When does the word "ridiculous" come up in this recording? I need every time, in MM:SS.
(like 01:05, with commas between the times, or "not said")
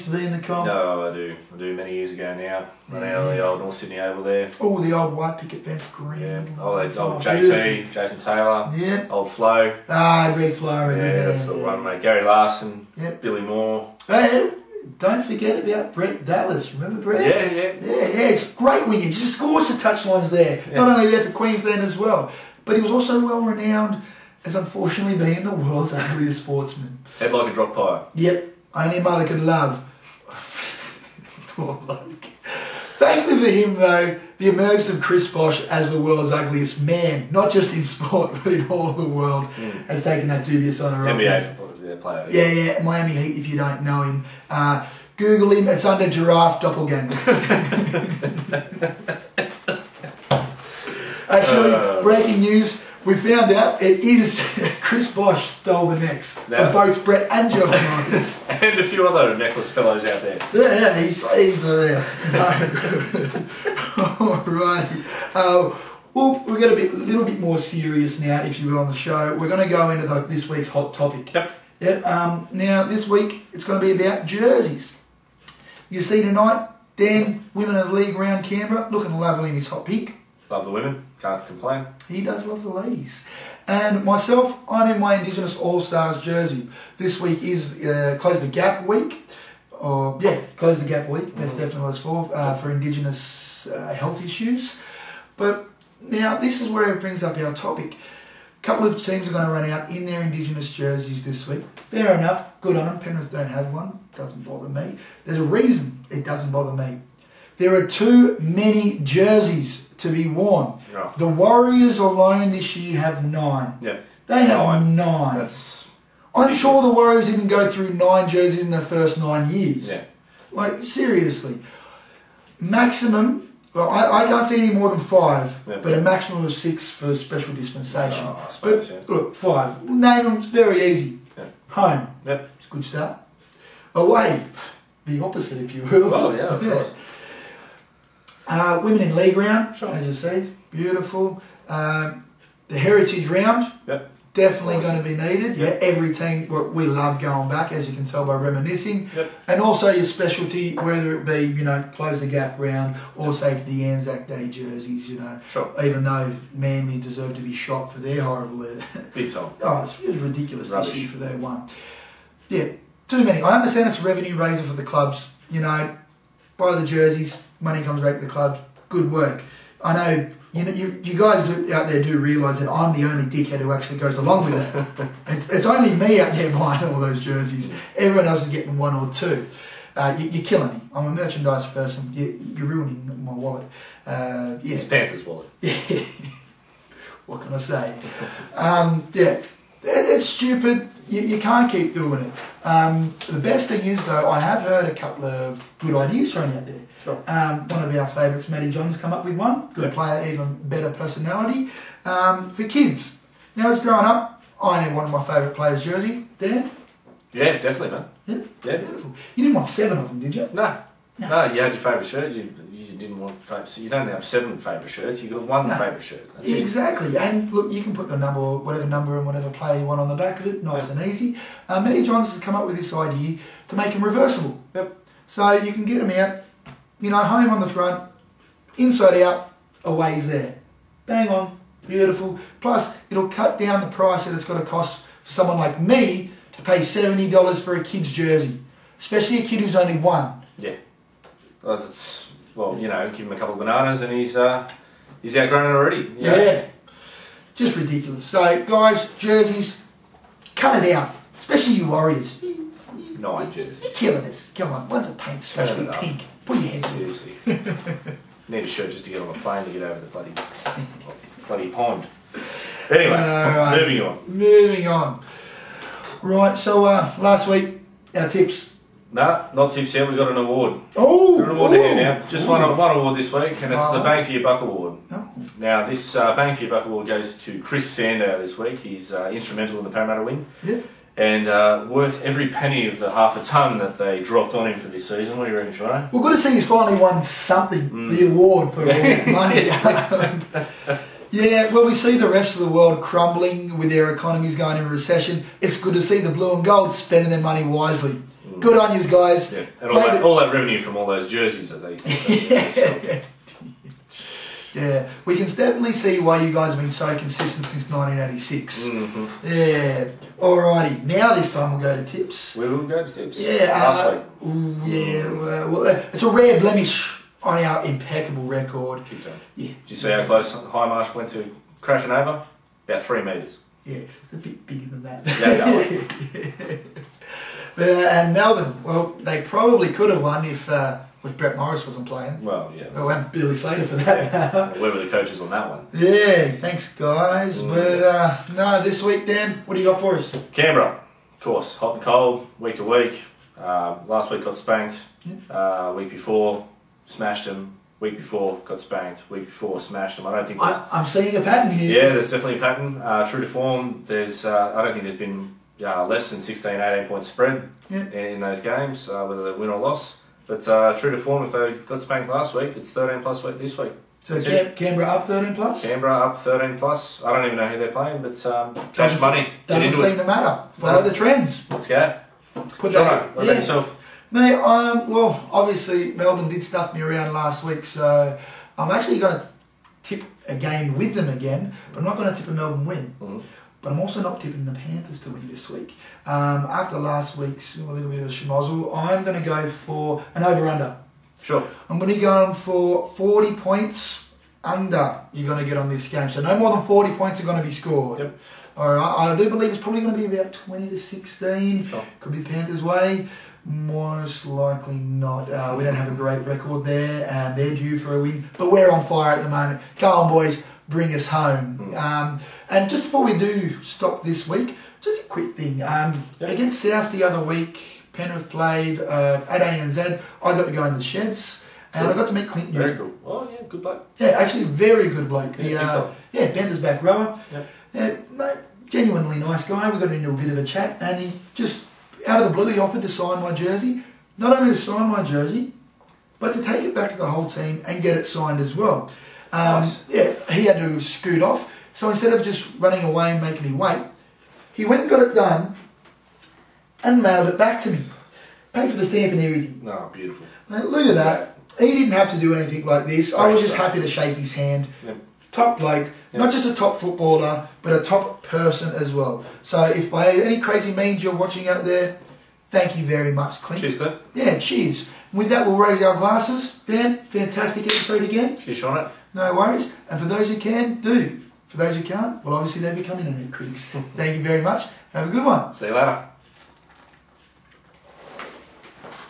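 01:56, 02:40, 04:07.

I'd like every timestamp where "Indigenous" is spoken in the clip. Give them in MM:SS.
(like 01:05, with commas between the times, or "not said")
01:25, 01:32, 01:40.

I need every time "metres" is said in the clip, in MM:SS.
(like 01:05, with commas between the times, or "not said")
05:23.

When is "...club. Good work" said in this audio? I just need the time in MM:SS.
02:48.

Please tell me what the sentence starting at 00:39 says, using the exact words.
has taken that dubious honour NBA off player.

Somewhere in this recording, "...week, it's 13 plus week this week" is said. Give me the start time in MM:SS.
06:02.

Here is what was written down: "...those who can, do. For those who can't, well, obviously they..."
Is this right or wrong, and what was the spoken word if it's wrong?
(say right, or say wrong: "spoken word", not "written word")
right.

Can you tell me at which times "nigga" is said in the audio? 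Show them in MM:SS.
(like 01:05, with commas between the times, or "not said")
not said.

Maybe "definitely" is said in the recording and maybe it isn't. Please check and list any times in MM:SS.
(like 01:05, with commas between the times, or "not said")
01:31, 02:24, 03:27, 05:05, 05:52.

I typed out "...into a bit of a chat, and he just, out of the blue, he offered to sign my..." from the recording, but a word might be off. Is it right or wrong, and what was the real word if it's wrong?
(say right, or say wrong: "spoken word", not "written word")
right.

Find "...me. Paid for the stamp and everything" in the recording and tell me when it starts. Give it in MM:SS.
07:27.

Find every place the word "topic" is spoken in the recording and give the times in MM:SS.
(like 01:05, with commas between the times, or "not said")
01:10, 01:37.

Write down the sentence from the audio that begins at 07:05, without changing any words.
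The, yeah, uh, yeah Bender's back rower.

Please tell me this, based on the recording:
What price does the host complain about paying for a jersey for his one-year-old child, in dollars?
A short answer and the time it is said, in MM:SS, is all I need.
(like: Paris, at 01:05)
70, at 03:56.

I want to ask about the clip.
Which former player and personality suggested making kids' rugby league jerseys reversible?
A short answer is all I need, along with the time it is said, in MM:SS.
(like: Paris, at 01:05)
Matty Johns, at 03:18.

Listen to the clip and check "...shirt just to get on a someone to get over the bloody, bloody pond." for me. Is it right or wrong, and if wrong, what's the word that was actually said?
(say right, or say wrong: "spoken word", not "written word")
wrong: "plane", not "someone".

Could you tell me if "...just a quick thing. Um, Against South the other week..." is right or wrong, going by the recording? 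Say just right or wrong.
right.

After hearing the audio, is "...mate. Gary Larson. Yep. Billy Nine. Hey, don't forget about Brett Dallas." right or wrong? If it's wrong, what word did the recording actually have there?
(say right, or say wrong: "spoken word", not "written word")
wrong: "Moore", not "Nine".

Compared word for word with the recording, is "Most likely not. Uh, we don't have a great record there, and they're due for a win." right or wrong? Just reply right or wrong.
right.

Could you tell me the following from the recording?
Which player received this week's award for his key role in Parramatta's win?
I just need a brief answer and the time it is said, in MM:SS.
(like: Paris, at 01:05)
Chris Sandow, at 04:37.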